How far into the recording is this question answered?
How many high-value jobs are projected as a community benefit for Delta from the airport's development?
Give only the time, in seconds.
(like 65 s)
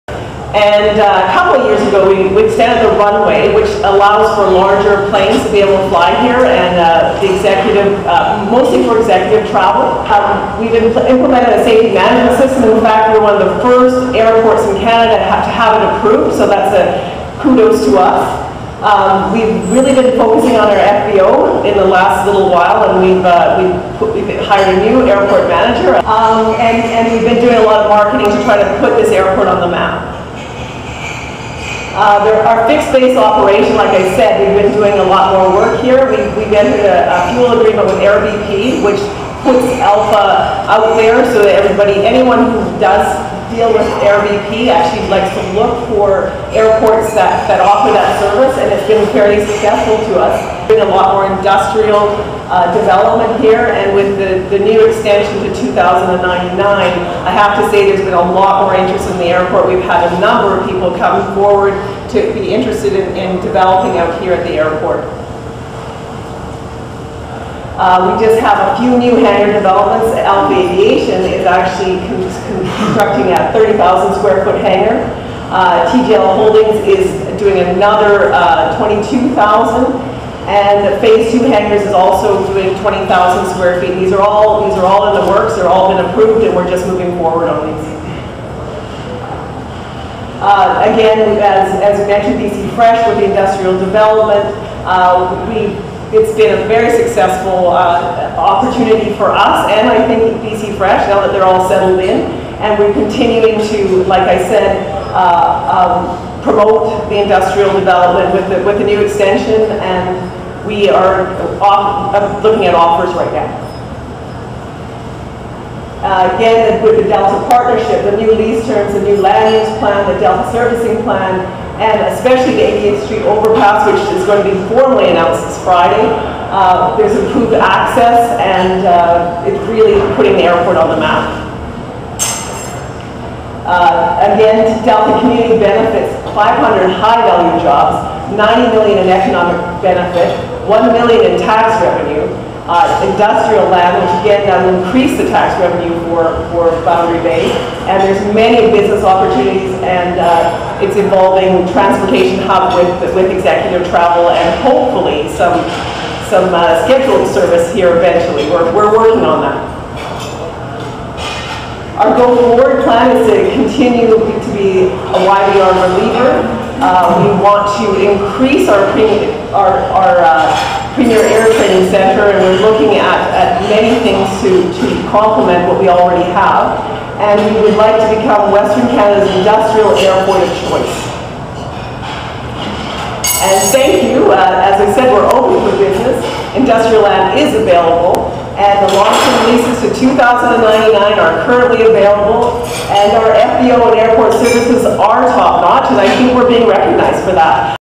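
136 s.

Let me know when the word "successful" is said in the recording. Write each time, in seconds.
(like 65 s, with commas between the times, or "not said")
49 s, 97 s.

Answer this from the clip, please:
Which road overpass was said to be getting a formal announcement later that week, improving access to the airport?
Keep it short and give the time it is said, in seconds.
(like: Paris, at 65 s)
88th Street overpass, at 122 s.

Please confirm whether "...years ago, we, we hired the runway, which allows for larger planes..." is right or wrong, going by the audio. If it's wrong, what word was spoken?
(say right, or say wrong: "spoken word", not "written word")
wrong: "extended", not "hired".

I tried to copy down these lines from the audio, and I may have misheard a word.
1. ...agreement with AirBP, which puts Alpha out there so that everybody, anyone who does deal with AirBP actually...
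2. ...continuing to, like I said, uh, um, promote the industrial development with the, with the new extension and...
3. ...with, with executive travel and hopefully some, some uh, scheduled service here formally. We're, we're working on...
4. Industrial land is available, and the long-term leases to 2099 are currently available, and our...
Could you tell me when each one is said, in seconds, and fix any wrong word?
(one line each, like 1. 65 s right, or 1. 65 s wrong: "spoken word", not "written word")
1. 37 s right
2. 102 s right
3. 152 s wrong: "eventually", not "formally"
4. 186 s right.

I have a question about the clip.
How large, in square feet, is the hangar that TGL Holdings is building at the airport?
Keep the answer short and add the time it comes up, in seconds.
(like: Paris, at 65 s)
22,000, at 78 s.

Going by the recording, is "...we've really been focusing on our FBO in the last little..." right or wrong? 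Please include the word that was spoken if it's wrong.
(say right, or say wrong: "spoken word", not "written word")
right.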